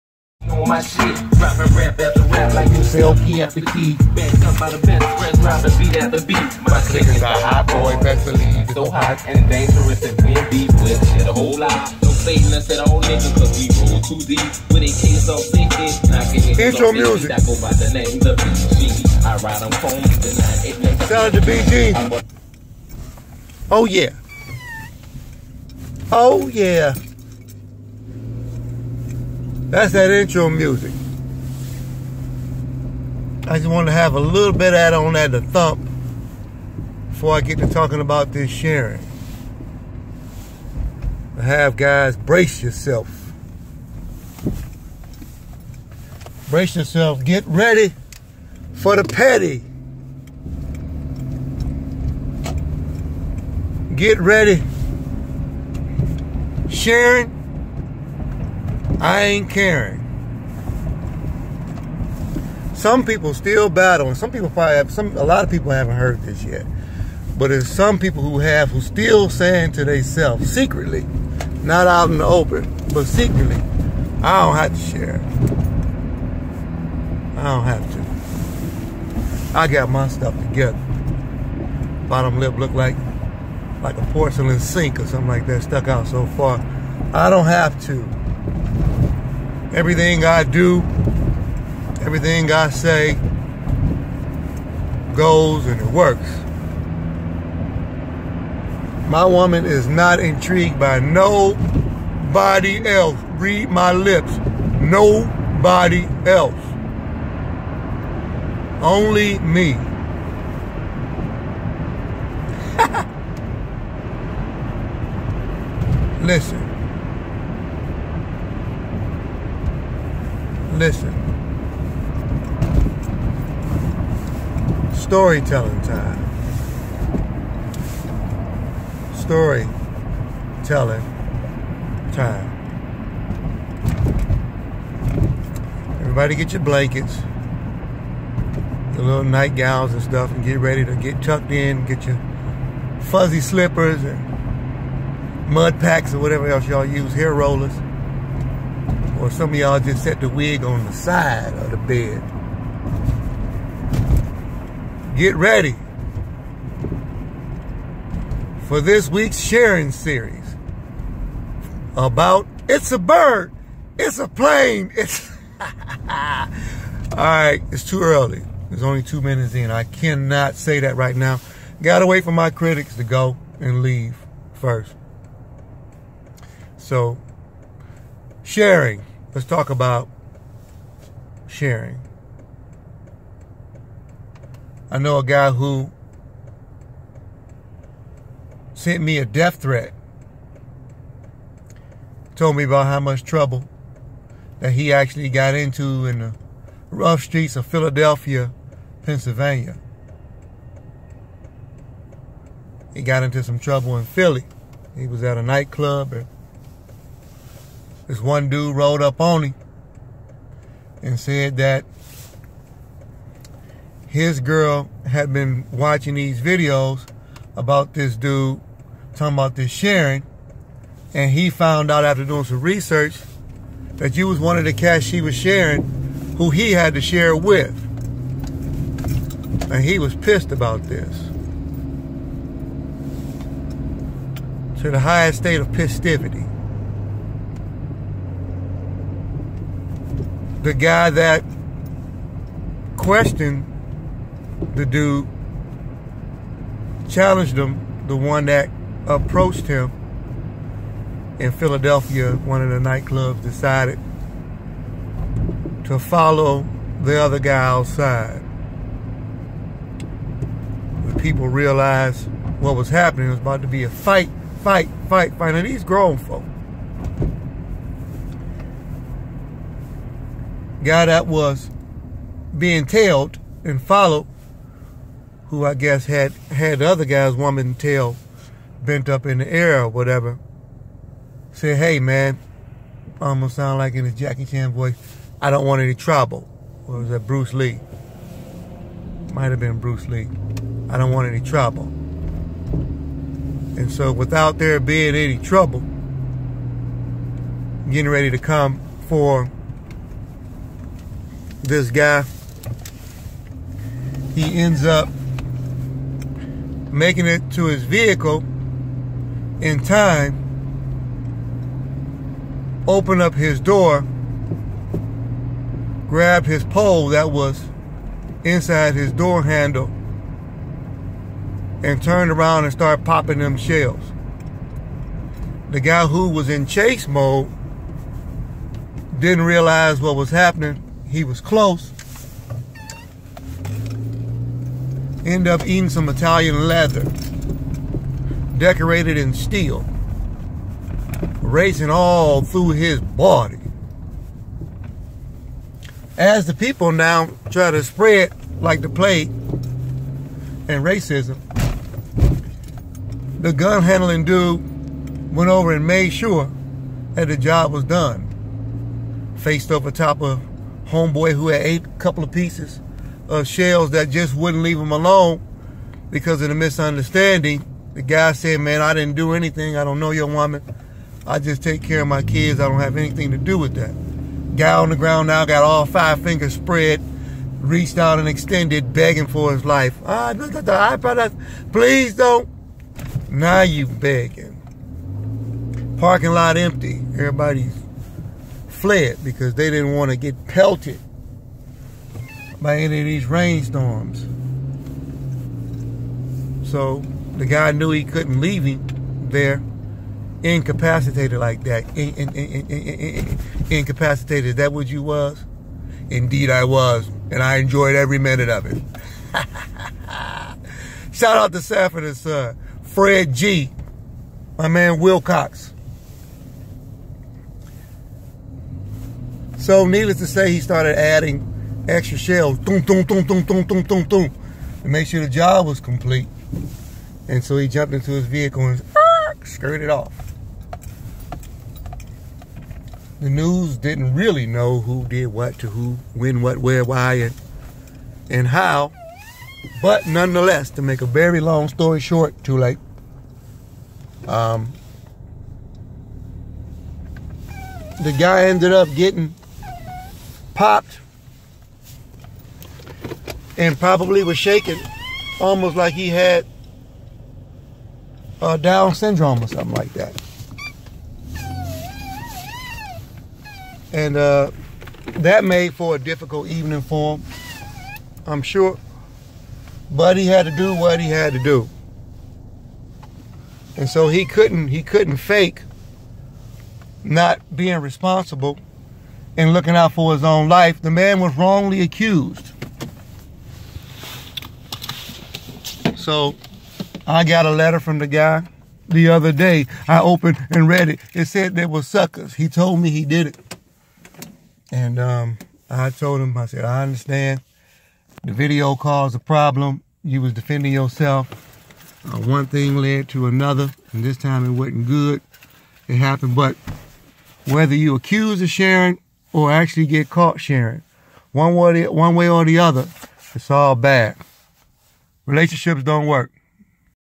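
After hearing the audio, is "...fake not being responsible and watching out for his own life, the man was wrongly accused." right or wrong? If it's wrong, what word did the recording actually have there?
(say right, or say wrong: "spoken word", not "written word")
wrong: "looking", not "watching".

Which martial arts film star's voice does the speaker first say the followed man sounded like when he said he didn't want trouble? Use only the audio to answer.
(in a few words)
Jackie Chan.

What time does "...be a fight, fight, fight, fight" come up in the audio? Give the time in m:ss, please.
4:23.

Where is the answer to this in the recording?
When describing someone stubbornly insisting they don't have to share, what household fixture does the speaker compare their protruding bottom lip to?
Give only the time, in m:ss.
1:24.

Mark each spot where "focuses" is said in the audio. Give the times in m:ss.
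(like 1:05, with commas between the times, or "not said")
not said.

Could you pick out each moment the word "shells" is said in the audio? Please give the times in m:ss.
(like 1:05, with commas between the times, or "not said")
5:23, 6:03, 7:02.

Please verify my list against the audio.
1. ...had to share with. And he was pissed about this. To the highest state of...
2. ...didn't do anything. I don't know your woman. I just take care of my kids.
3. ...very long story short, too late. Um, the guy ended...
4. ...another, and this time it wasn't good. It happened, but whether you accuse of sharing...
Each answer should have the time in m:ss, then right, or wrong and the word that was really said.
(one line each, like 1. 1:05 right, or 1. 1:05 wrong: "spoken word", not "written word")
1. 3:46 right
2. 6:08 right
3. 7:21 right
4. 8:23 right.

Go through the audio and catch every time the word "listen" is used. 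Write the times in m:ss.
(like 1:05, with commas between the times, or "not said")
1:56, 2:00.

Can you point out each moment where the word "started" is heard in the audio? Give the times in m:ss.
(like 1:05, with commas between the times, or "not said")
5:22, 7:00.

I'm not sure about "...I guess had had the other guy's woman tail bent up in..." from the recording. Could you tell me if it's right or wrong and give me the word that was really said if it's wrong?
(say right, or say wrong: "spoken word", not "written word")
right.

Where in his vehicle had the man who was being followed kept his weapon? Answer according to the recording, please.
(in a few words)
door handle.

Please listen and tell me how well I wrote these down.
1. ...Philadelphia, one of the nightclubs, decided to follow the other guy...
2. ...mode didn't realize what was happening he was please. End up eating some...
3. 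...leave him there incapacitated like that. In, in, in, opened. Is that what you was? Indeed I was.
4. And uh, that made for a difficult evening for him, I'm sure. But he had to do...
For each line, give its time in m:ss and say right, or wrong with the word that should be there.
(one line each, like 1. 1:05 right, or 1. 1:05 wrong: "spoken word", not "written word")
1. 4:11 right
2. 5:27 wrong: "close", not "please"
3. 6:38 wrong: "incapacitated", not "opened"
4. 7:43 right.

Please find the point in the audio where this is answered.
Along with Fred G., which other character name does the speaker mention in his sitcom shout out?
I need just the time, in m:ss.
6:54.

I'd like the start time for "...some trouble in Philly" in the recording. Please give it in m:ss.
3:23.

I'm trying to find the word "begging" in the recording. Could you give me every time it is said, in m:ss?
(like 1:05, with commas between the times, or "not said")
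6:18, 6:23.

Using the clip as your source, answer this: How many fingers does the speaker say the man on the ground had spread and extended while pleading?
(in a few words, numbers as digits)
5.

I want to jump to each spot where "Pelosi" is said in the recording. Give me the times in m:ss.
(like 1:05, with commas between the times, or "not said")
not said.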